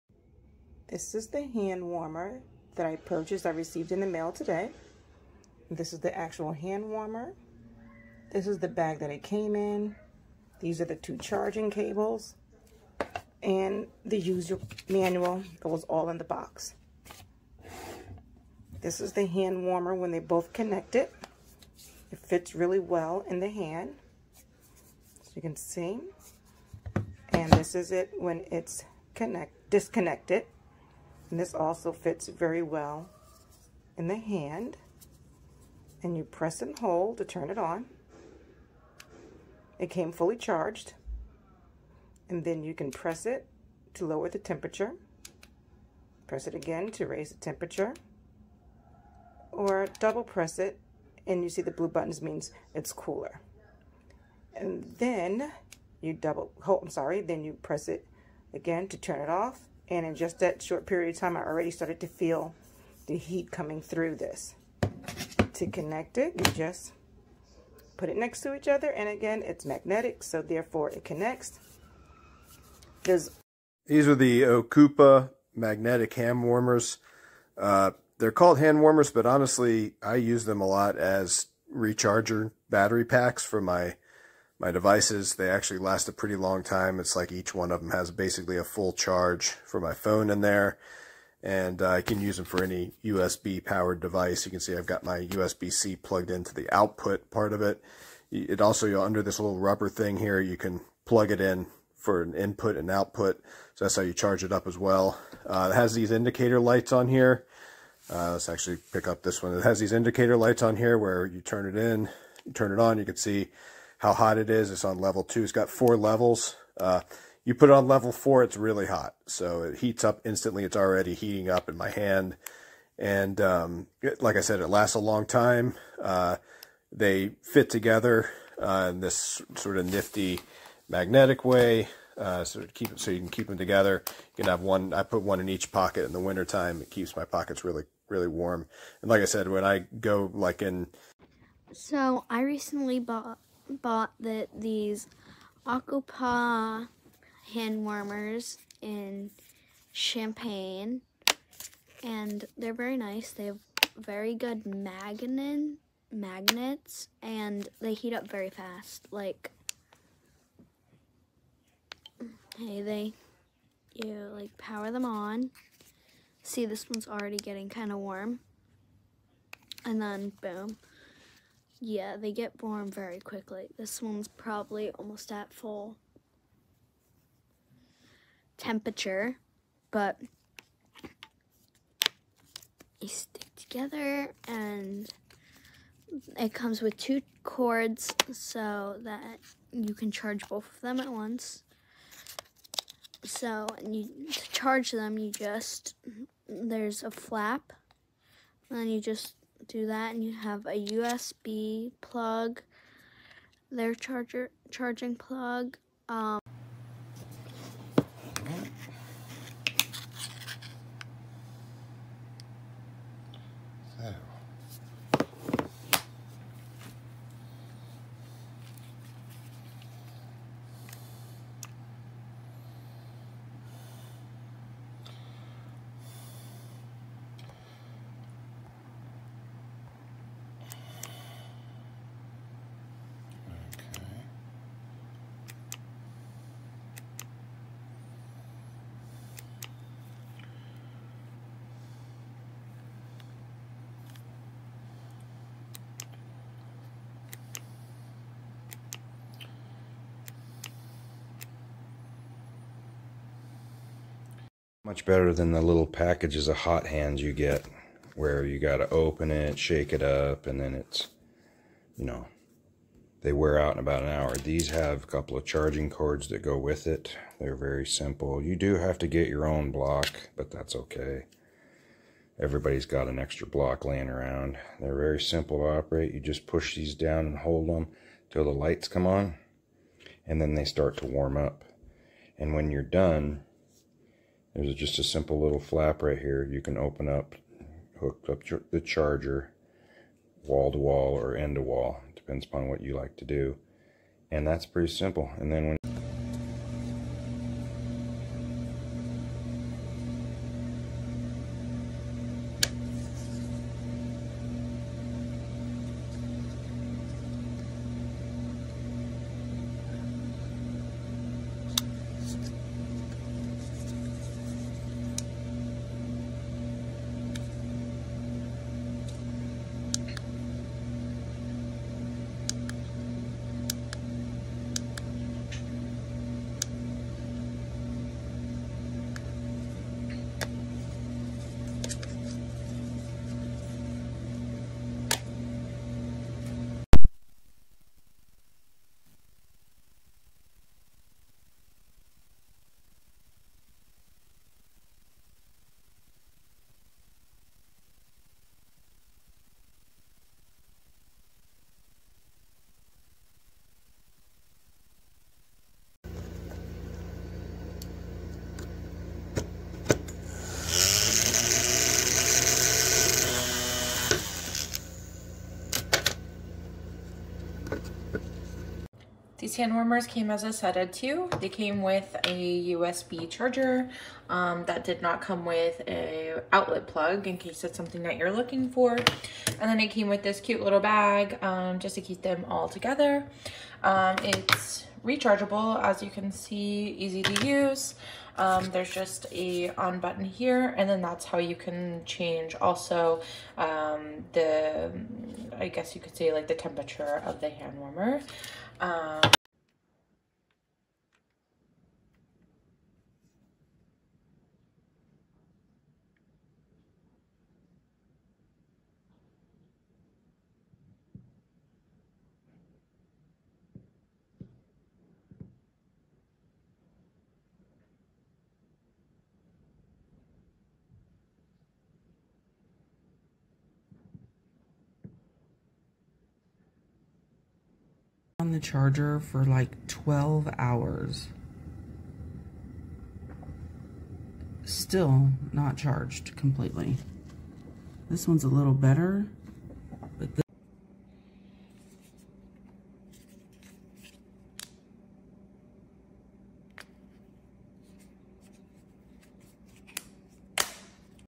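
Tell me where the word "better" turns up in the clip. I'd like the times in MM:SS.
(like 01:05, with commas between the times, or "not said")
04:15, 07:18.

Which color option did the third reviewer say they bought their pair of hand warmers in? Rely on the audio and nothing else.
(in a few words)
Champagne.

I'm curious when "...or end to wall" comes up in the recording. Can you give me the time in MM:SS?
04:51.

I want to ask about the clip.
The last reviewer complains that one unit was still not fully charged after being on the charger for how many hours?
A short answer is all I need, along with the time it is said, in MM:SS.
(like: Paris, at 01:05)
12 hours, at 07:09.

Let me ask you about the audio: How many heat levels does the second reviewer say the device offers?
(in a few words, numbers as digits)
4.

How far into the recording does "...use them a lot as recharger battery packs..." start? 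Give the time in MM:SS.
01:20.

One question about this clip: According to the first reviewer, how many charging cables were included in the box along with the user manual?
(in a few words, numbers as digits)
2.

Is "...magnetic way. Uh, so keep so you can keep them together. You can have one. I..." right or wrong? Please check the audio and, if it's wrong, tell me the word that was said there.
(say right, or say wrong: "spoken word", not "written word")
right.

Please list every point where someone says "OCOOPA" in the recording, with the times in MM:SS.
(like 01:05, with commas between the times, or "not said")
01:14, 02:25.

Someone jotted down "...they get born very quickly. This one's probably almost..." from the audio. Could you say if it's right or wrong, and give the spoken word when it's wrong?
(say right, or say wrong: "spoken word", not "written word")
right.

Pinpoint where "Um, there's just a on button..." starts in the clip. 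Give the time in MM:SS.
06:28.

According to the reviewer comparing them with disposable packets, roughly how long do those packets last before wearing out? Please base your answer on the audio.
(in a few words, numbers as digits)
About an hour.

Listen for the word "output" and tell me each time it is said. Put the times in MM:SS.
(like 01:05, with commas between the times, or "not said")
01:36, 01:42.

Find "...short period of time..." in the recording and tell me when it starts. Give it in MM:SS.
01:00.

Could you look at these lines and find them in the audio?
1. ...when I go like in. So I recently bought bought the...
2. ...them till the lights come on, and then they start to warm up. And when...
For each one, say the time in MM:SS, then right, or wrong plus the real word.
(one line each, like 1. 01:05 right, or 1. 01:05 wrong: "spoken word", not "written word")
1. 02:19 right
2. 04:37 right.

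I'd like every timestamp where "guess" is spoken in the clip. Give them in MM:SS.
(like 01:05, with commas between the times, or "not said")
06:35.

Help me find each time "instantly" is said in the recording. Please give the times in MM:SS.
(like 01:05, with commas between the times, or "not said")
02:00.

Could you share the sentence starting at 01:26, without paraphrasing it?
It's like each one of them has basically a full charge for my phone in there.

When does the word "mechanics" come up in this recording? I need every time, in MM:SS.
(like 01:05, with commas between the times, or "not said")
not said.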